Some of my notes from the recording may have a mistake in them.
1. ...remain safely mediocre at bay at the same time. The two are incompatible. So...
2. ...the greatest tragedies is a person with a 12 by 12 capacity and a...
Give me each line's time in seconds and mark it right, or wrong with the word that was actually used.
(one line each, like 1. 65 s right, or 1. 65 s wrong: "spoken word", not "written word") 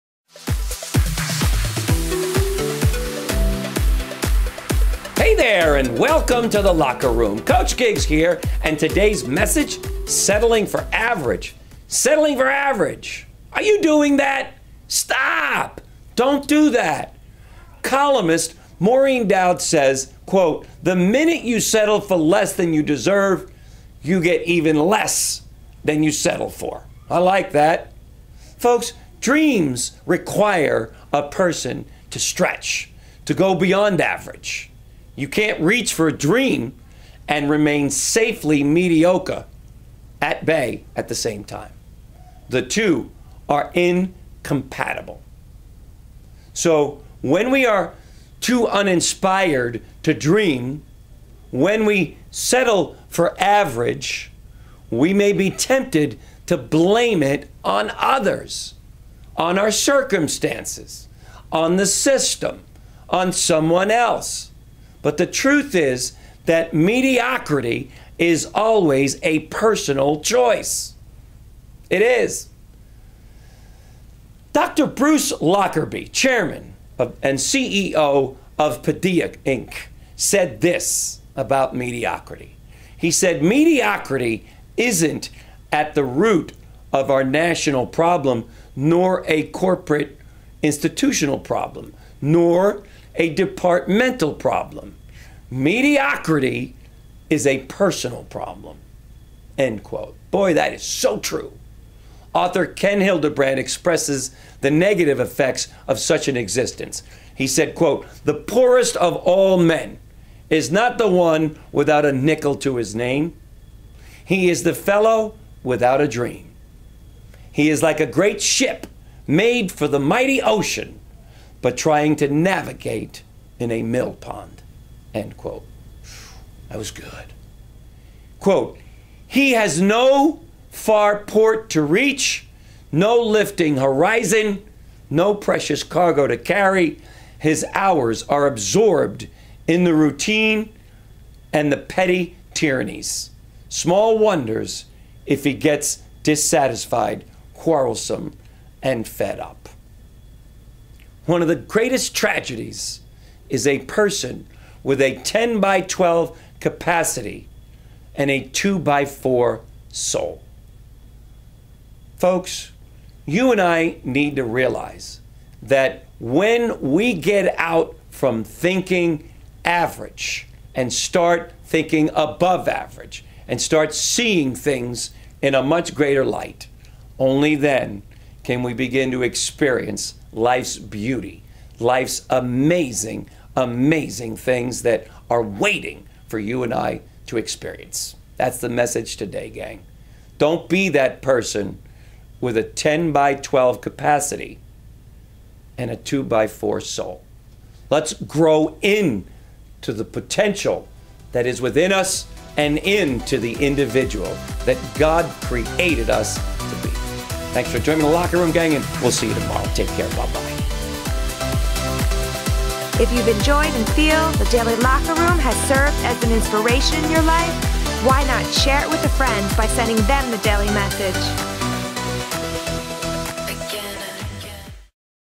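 1. 37 s right
2. 151 s wrong: "10", not "12".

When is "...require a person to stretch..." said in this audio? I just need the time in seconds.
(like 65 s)
30 s.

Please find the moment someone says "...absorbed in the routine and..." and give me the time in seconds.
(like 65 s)
138 s.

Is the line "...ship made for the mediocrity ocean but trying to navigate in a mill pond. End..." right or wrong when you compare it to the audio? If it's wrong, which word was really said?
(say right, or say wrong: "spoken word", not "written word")
wrong: "mighty", not "mediocrity".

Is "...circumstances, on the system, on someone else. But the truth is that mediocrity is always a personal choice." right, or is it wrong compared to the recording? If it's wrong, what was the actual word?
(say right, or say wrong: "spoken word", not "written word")
right.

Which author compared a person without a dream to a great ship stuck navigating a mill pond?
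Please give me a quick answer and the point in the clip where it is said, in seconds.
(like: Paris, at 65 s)
Ken Hildebrand, at 102 s.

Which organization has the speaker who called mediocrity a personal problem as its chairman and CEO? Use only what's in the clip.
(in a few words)
Paideia Inc.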